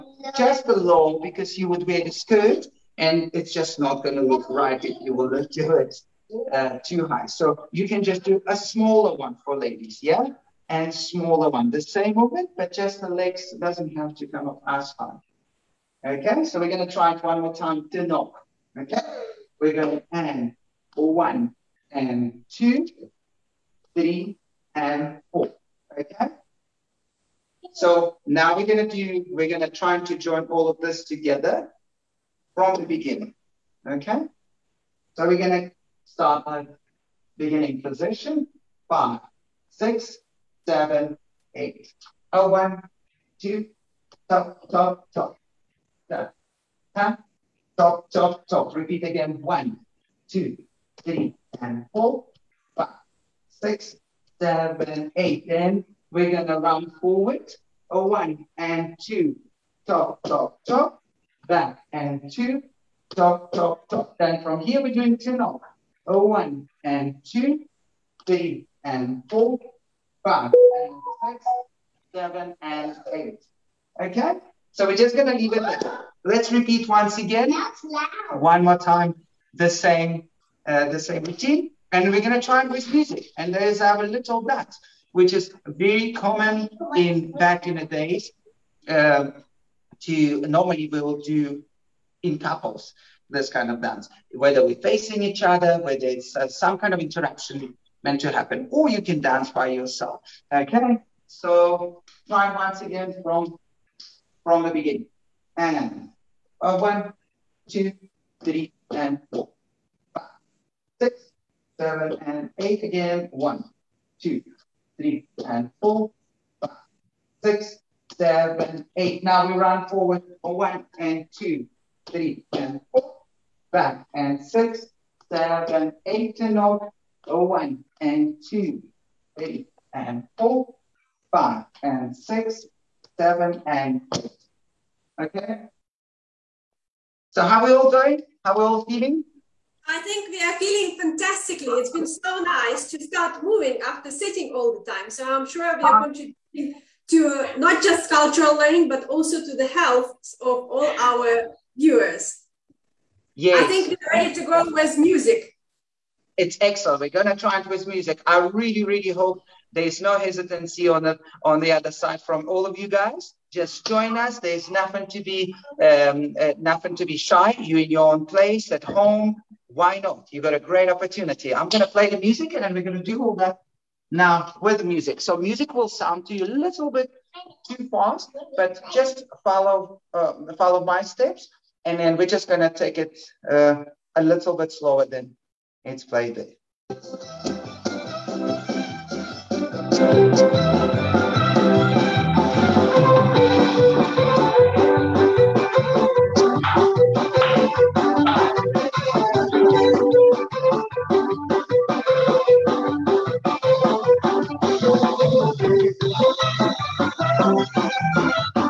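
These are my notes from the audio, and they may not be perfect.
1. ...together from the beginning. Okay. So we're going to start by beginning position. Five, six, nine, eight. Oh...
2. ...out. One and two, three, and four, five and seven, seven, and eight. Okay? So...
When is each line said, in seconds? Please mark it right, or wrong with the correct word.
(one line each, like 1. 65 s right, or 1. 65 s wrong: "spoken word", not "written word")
1. 31 s wrong: "seven", not "nine"
2. 126 s wrong: "six", not "seven".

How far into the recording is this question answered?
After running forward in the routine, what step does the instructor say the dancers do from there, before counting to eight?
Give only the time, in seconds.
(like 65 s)
65 s.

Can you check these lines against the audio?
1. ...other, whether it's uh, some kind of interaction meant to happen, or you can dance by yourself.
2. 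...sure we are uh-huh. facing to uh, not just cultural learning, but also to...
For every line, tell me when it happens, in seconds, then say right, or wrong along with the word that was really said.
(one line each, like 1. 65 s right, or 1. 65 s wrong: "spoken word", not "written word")
1. 95 s right
2. 145 s wrong: "contributing", not "facing".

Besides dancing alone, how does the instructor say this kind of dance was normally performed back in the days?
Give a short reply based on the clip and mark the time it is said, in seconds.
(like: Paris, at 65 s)
In couples, at 92 s.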